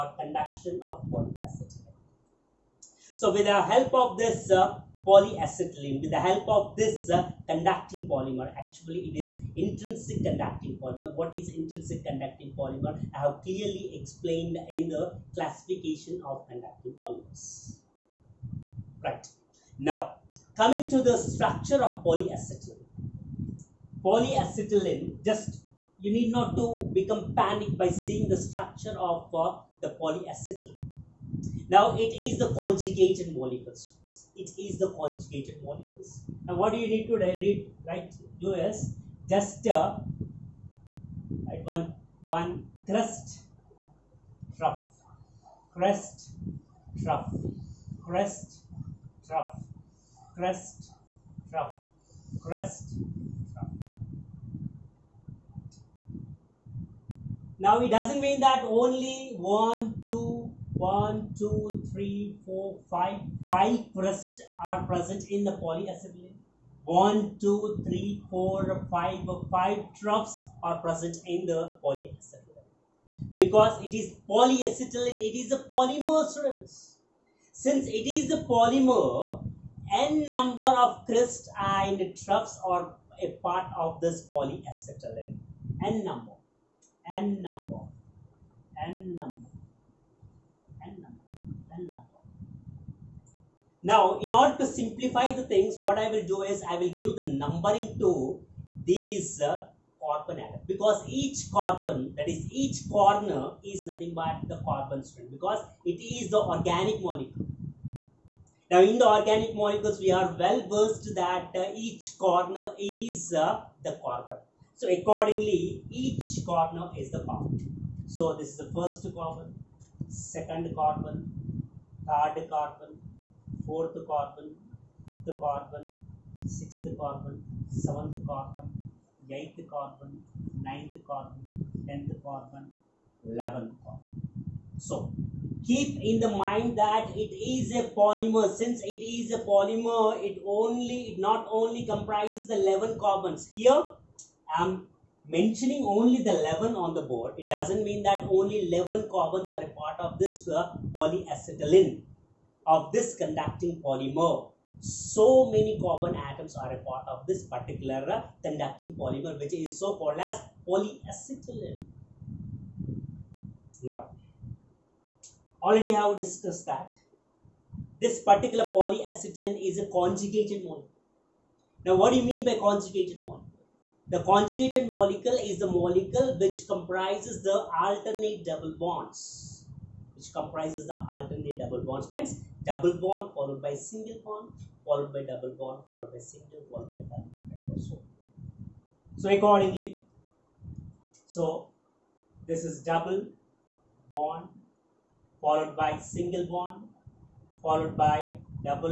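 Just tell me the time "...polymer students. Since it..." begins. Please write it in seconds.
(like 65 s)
75 s.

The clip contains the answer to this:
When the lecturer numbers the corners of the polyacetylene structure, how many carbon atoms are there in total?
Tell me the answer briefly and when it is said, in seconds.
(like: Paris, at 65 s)
11, at 133 s.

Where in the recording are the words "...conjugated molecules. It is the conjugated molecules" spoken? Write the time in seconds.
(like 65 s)
32 s.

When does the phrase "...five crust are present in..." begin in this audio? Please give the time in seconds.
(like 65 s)
63 s.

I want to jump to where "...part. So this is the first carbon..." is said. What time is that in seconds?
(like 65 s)
117 s.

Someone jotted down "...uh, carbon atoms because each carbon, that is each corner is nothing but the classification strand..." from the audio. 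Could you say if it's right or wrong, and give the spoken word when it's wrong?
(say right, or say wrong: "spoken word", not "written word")
wrong: "carbon", not "classification".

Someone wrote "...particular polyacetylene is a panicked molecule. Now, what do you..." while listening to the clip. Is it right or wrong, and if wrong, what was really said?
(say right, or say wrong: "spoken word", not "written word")
wrong: "conjugated", not "panicked".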